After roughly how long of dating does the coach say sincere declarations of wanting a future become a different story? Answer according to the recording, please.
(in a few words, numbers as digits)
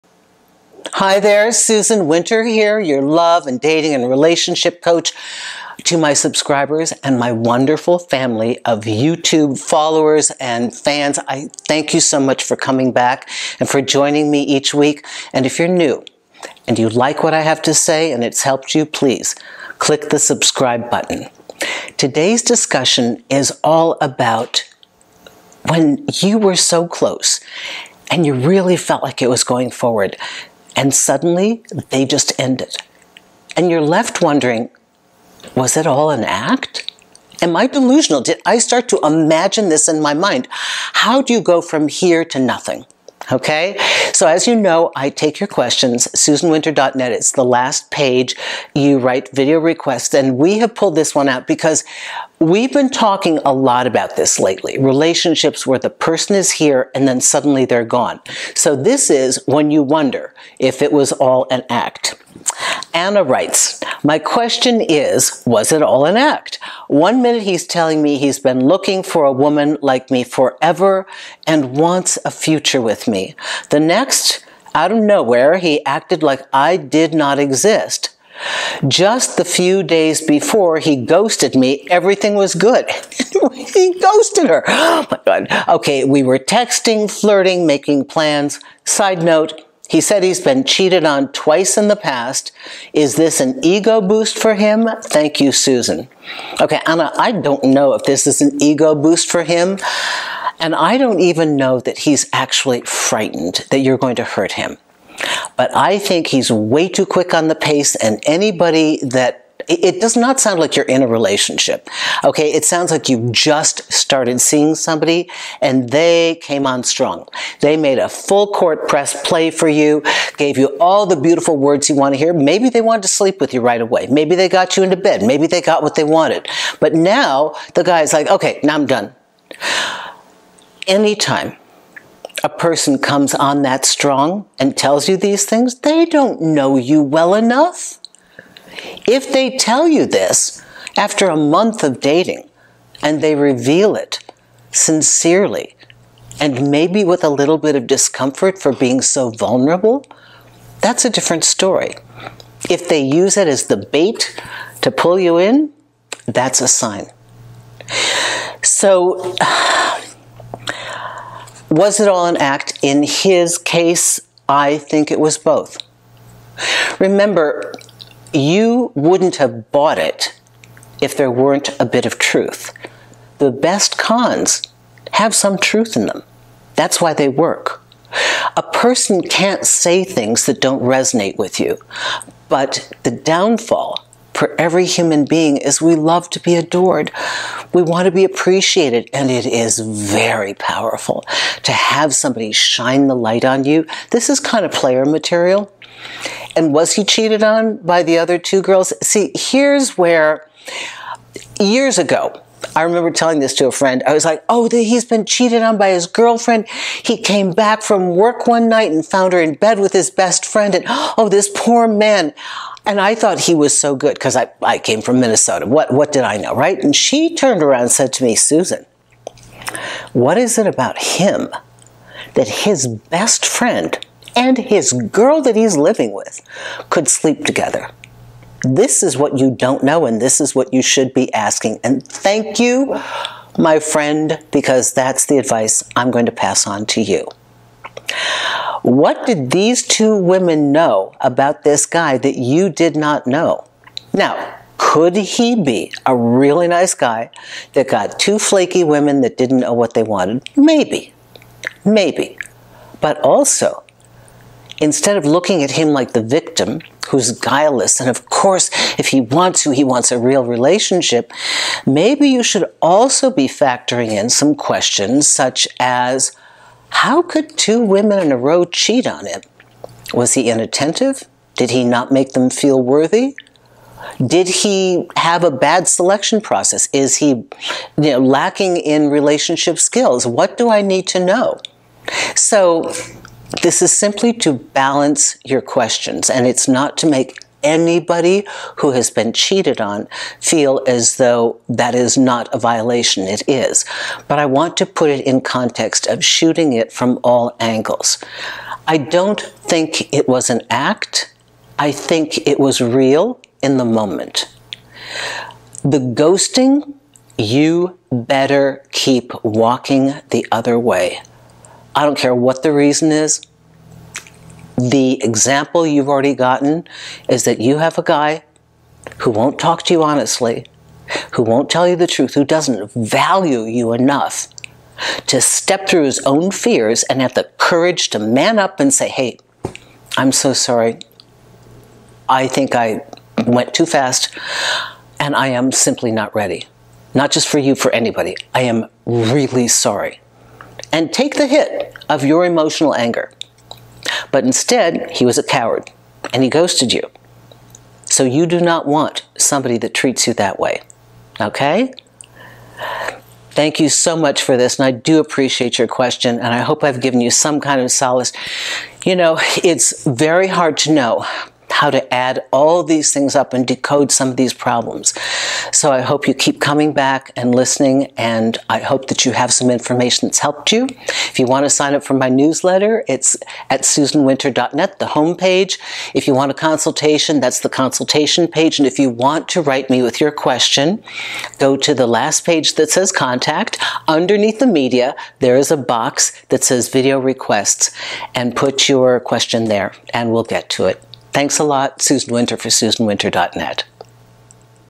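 a month.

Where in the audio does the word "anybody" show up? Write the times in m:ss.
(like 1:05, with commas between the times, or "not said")
1:48, 4:47, 5:37.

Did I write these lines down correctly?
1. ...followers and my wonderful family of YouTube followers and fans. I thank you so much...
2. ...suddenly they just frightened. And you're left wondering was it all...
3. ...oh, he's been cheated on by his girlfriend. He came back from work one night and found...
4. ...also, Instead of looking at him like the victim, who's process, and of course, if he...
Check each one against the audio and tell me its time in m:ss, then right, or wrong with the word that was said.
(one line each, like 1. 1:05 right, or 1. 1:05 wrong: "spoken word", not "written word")
1. 0:06 wrong: "subscribers", not "followers"
2. 0:30 wrong: "ended", not "frightened"
3. 3:24 right
4. 4:13 wrong: "guileless", not "process".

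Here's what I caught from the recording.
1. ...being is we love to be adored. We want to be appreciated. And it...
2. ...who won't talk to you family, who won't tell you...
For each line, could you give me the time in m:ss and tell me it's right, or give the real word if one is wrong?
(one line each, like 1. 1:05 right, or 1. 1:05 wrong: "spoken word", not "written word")
1. 3:05 right
2. 5:19 wrong: "honestly", not "family".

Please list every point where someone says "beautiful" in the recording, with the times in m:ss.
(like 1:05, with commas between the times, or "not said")
2:01.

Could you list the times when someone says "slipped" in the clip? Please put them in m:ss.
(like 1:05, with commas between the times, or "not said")
not said.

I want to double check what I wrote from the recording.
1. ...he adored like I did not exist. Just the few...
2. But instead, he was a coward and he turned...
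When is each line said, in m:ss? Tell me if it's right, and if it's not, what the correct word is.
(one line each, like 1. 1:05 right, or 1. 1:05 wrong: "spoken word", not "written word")
1. 1:15 wrong: "acted", not "adored"
2. 5:44 wrong: "ghosted", not "turned".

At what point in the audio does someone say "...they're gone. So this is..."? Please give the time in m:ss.
0:57.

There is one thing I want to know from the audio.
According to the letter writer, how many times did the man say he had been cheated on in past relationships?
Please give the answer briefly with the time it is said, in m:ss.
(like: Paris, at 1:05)
twice, at 1:31.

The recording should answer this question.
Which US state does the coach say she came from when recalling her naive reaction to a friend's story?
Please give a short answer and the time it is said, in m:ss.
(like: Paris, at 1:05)
Minnesota, at 3:35.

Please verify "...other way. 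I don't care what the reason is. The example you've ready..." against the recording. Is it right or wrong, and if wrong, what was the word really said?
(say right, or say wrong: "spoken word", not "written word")
wrong: "already", not "ready".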